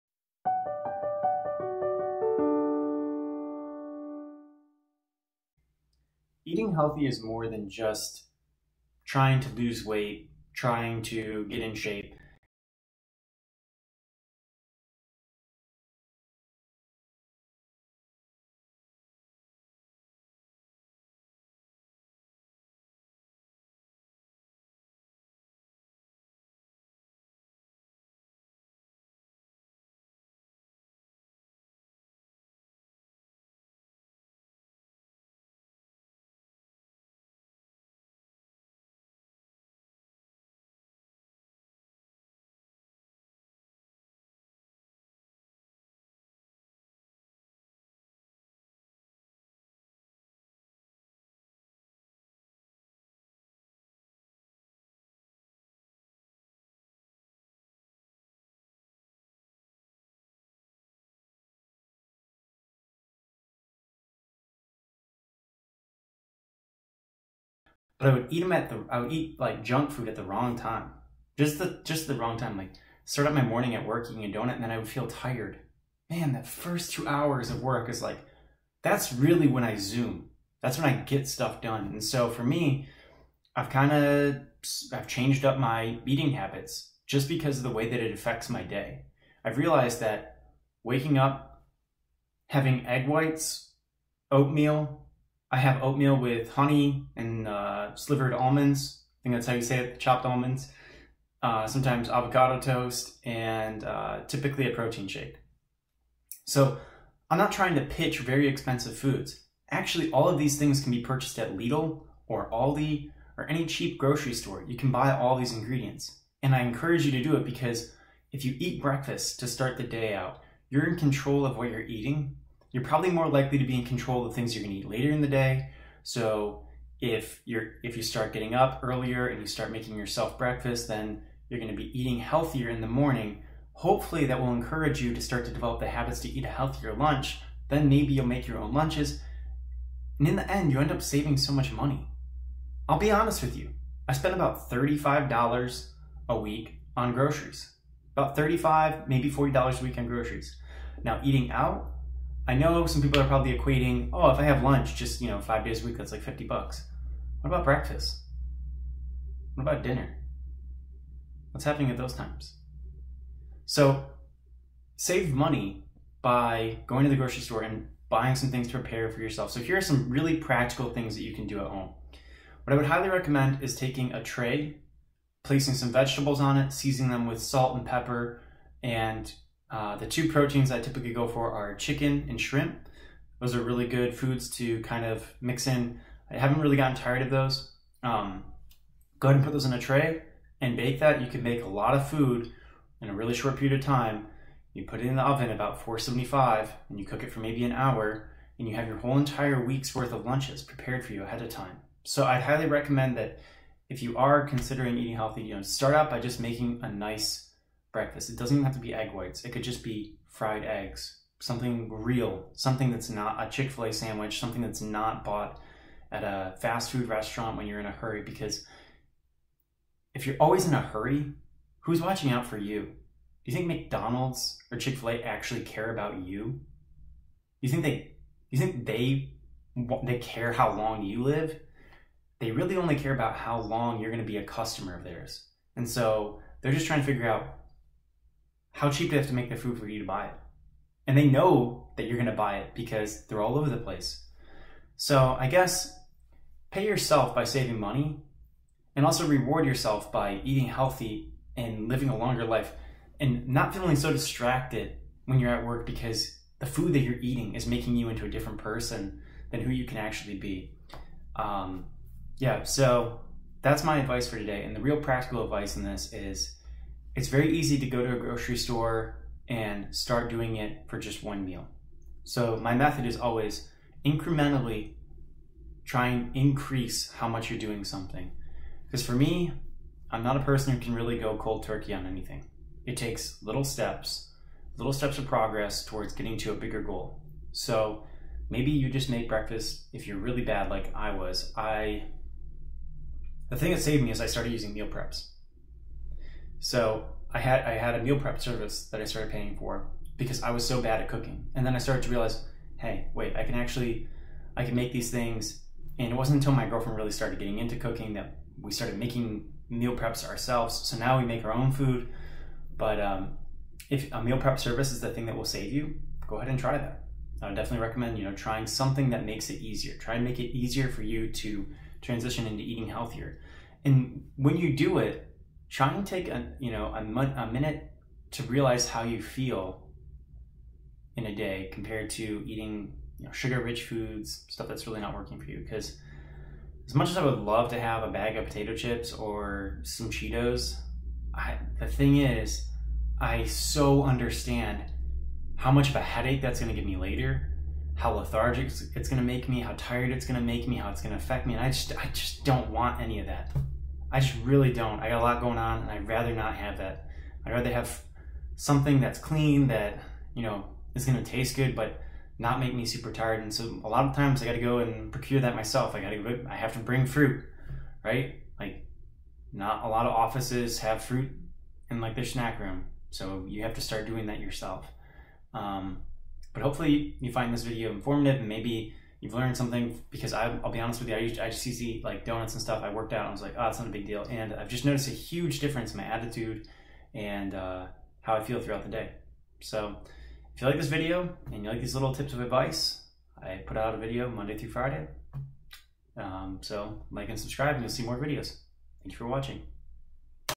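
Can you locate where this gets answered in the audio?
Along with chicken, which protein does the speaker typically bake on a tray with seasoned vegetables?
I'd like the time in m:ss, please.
3:02.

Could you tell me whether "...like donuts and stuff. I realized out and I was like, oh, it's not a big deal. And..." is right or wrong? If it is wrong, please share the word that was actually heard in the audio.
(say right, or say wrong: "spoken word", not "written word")
wrong: "worked", not "realized".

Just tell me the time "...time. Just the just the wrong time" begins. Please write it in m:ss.
1:10.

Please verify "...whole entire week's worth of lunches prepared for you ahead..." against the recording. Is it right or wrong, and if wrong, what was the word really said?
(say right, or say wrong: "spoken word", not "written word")
right.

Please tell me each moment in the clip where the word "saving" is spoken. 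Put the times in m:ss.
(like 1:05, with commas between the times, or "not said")
2:21, 4:07.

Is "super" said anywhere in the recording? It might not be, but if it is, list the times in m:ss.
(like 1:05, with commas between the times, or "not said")
6:02.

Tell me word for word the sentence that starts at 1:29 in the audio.
I've realized that waking up, having egg whites, oatmeal, I have oatmeal with honey and uh, slivered almonds.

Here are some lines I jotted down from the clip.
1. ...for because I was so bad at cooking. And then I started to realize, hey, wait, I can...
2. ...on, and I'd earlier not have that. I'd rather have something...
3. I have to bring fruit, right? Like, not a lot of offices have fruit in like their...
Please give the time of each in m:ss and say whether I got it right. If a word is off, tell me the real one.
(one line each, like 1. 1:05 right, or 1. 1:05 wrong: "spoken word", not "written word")
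1. 4:59 right
2. 5:55 wrong: "rather", not "earlier"
3. 6:06 right.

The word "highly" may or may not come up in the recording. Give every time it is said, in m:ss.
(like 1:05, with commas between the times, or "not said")
2:52, 3:22.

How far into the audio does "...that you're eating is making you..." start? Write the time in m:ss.
4:16.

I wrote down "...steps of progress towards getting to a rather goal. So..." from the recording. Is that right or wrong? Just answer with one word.
wrong.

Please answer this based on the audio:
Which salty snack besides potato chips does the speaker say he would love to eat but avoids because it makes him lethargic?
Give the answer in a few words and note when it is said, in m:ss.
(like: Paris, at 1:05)
Cheetos, at 5:40.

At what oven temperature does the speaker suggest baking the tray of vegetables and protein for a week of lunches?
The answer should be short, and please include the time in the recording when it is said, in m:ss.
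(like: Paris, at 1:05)
475, at 3:15.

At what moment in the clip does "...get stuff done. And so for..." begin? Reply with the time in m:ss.
1:21.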